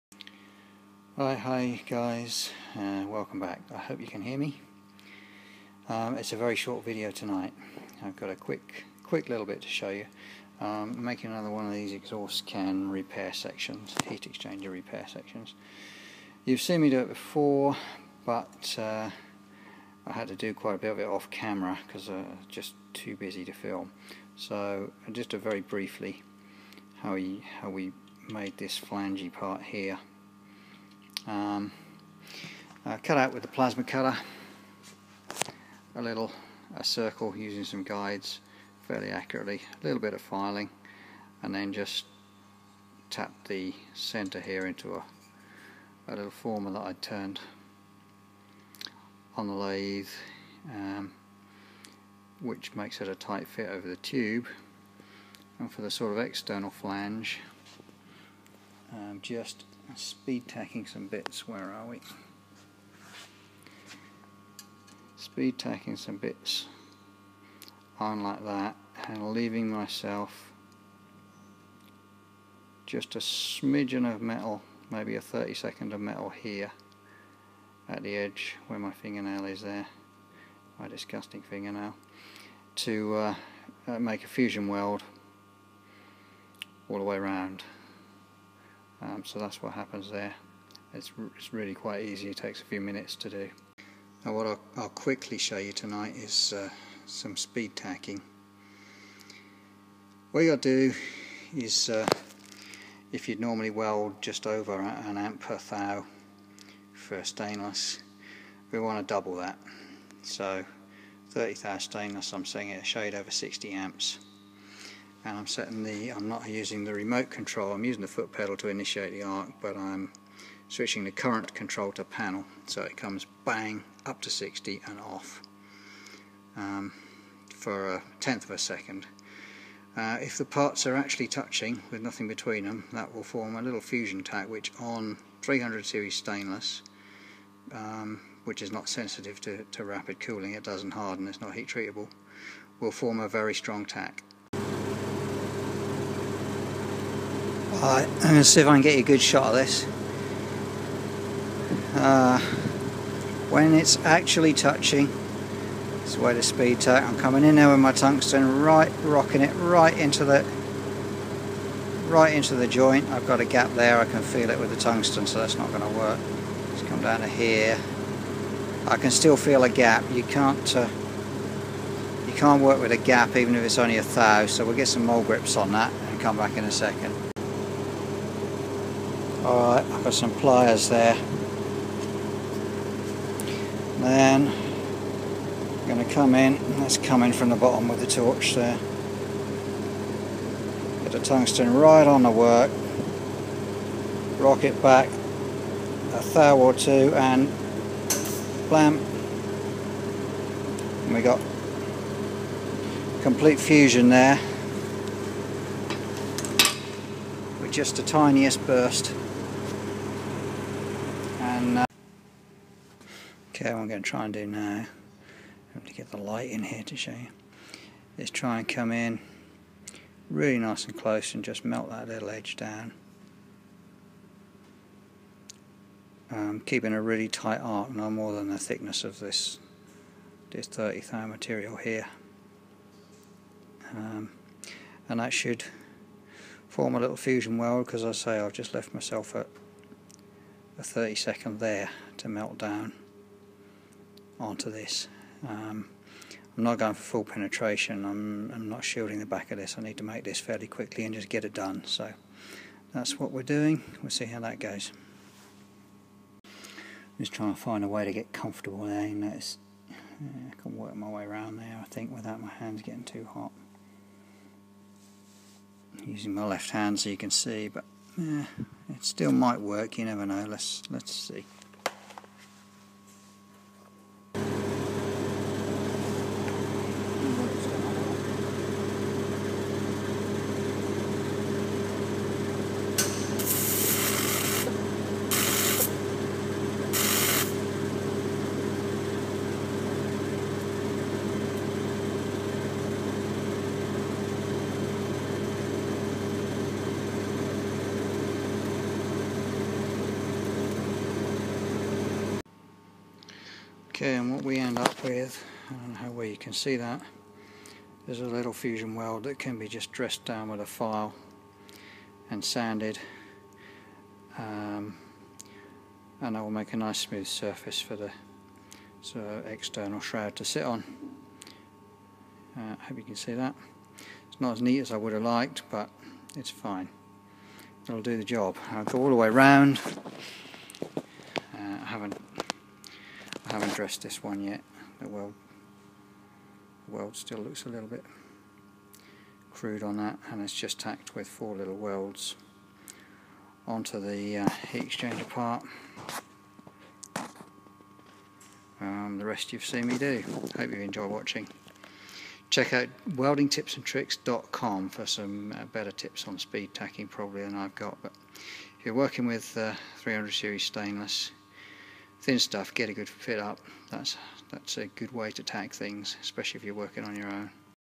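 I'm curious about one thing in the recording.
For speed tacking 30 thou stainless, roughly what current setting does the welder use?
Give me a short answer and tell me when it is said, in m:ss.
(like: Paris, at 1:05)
60 amps, at 1:53.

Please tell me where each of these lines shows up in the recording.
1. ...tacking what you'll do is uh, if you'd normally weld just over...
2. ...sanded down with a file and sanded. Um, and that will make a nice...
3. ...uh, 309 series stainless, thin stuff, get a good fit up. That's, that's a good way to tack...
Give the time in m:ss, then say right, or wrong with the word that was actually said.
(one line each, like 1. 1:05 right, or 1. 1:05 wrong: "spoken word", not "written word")
1. 1:37 right
2. 5:09 wrong: "dressed", not "sanded"
3. 5:59 wrong: "300", not "309".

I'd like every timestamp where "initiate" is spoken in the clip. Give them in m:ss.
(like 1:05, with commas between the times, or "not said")
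1:58.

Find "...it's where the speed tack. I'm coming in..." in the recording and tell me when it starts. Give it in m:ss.
2:36.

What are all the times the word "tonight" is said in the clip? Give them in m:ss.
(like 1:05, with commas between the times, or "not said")
0:07, 1:35.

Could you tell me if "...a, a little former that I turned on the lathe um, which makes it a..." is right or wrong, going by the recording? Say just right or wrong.
right.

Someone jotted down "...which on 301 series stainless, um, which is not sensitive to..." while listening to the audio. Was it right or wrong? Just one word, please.
wrong.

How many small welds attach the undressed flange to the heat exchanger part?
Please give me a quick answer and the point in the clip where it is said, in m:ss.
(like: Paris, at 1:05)
4, at 5:41.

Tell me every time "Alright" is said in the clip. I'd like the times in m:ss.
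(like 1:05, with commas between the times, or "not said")
2:27, 2:59.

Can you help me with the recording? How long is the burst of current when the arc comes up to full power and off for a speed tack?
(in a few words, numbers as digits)
a tenth of a second.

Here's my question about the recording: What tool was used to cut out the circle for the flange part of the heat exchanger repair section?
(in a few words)
plasma cutter.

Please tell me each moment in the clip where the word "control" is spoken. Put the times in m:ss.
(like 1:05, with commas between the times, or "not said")
1:57, 2:01.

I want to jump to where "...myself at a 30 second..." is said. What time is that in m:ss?
3:58.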